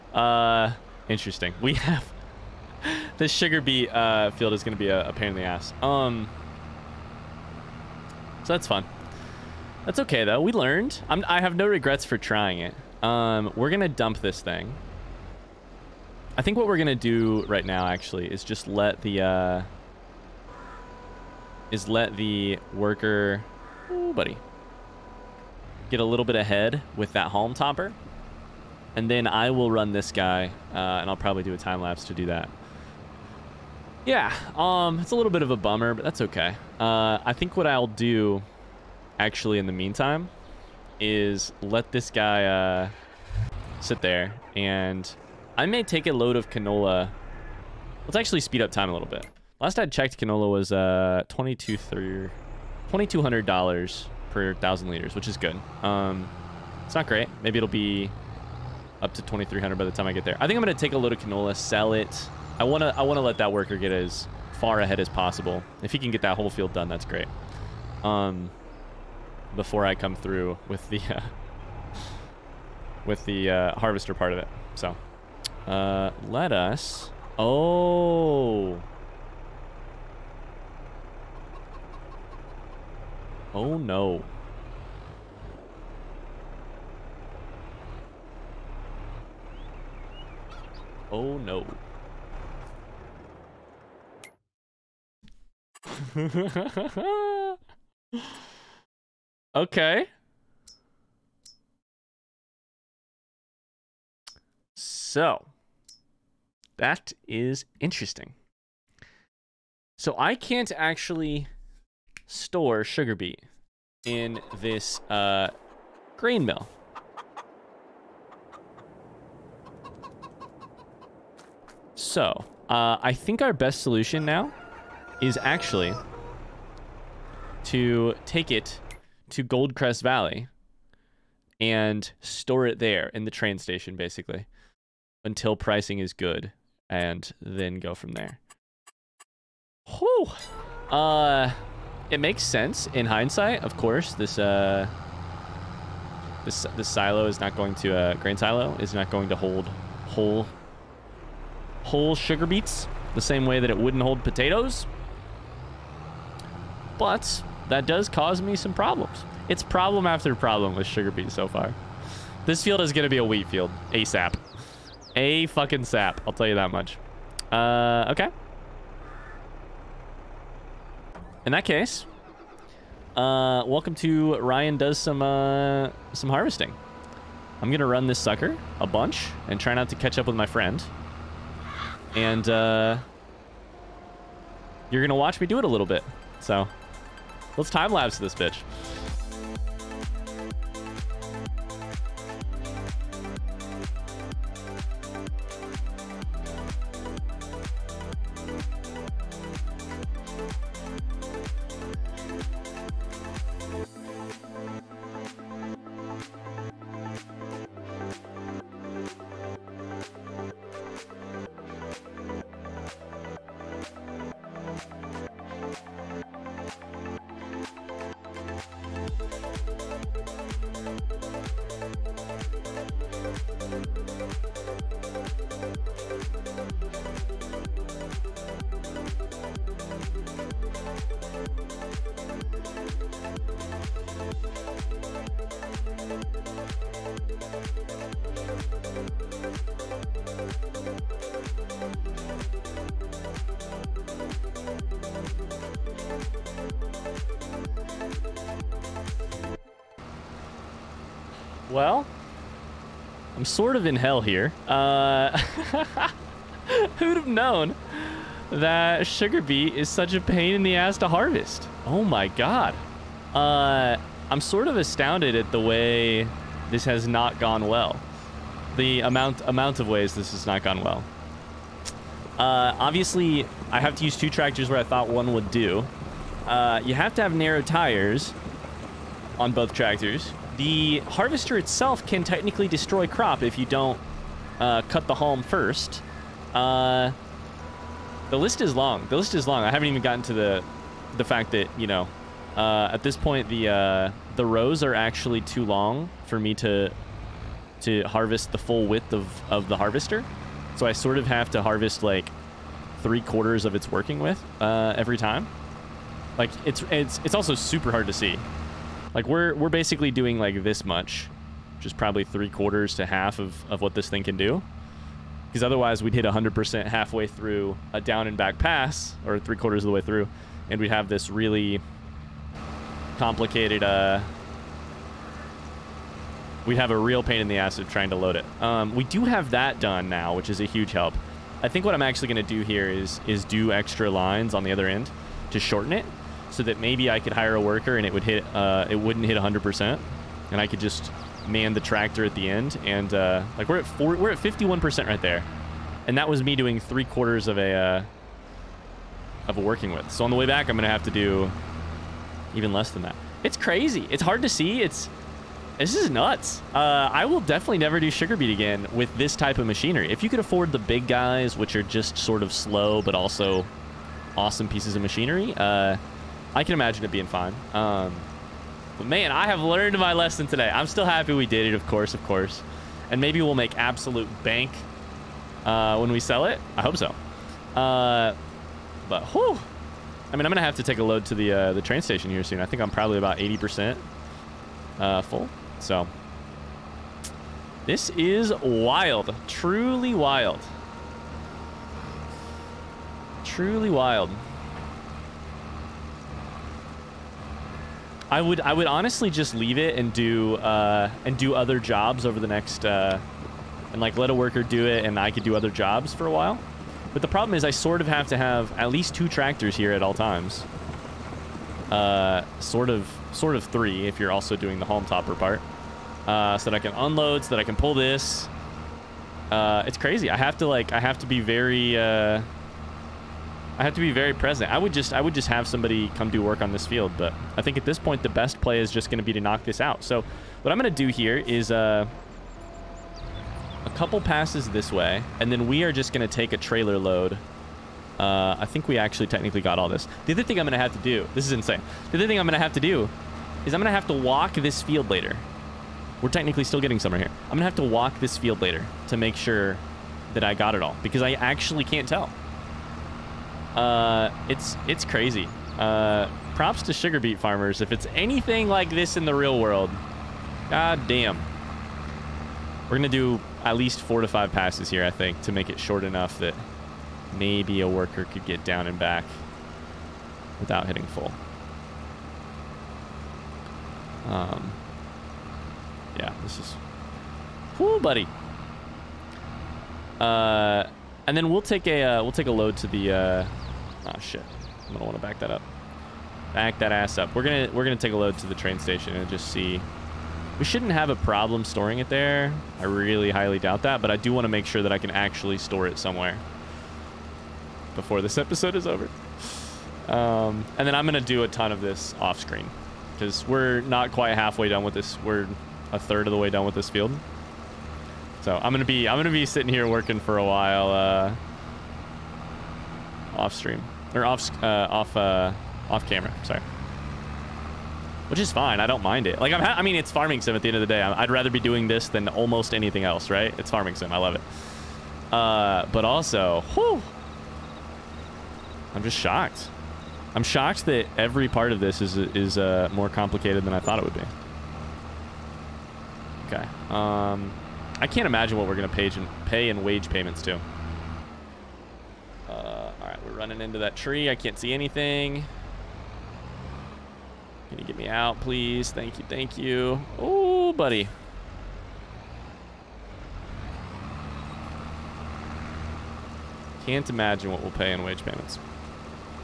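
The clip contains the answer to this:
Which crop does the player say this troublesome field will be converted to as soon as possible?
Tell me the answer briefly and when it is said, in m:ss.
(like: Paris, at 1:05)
Wheat, at 2:43.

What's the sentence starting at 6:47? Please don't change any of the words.
But the problem is I sort of have to have at least two tractors here at all times.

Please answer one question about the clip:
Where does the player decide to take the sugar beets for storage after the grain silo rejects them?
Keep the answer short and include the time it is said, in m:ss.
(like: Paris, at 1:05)
Goldcrest Valley, at 2:09.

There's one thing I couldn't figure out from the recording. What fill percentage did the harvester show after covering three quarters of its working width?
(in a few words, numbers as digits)
51%.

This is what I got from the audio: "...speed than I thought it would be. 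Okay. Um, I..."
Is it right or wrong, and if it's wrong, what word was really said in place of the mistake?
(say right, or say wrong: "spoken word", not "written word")
wrong: "complicated", not "speed".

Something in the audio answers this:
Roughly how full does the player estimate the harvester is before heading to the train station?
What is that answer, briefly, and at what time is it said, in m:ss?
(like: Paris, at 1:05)
80%, at 6:23.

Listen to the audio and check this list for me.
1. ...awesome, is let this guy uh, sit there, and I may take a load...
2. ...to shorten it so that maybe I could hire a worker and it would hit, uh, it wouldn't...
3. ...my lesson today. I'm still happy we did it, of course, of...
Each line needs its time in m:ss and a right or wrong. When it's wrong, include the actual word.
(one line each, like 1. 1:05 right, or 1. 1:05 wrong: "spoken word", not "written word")
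1. 0:39 wrong: "meantime", not "awesome"
2. 5:35 right
3. 6:09 right.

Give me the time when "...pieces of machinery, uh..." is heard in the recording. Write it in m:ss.
6:04.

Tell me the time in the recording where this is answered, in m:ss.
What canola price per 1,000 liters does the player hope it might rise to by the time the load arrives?
0:59.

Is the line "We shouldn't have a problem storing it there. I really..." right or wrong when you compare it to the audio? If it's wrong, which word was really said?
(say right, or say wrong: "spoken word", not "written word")
right.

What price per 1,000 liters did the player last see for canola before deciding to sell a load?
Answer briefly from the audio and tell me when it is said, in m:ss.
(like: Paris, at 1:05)
$2,200, at 0:51.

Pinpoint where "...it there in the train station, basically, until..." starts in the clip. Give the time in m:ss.
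2:12.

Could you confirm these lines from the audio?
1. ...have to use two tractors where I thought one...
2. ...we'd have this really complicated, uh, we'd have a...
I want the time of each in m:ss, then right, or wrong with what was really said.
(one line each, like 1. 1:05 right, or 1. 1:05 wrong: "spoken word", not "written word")
1. 4:33 right
2. 5:20 right.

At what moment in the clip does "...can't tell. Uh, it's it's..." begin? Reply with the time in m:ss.
7:31.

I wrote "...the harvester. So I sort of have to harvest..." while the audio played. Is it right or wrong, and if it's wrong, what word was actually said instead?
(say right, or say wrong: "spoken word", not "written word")
right.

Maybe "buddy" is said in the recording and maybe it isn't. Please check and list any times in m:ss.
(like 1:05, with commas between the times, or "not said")
0:24, 7:58, 9:10.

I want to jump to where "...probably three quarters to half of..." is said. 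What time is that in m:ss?
5:11.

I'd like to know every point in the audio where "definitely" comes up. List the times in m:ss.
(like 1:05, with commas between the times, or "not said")
5:57.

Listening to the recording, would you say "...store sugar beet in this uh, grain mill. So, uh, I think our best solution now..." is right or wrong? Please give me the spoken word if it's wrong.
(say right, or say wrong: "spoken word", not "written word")
right.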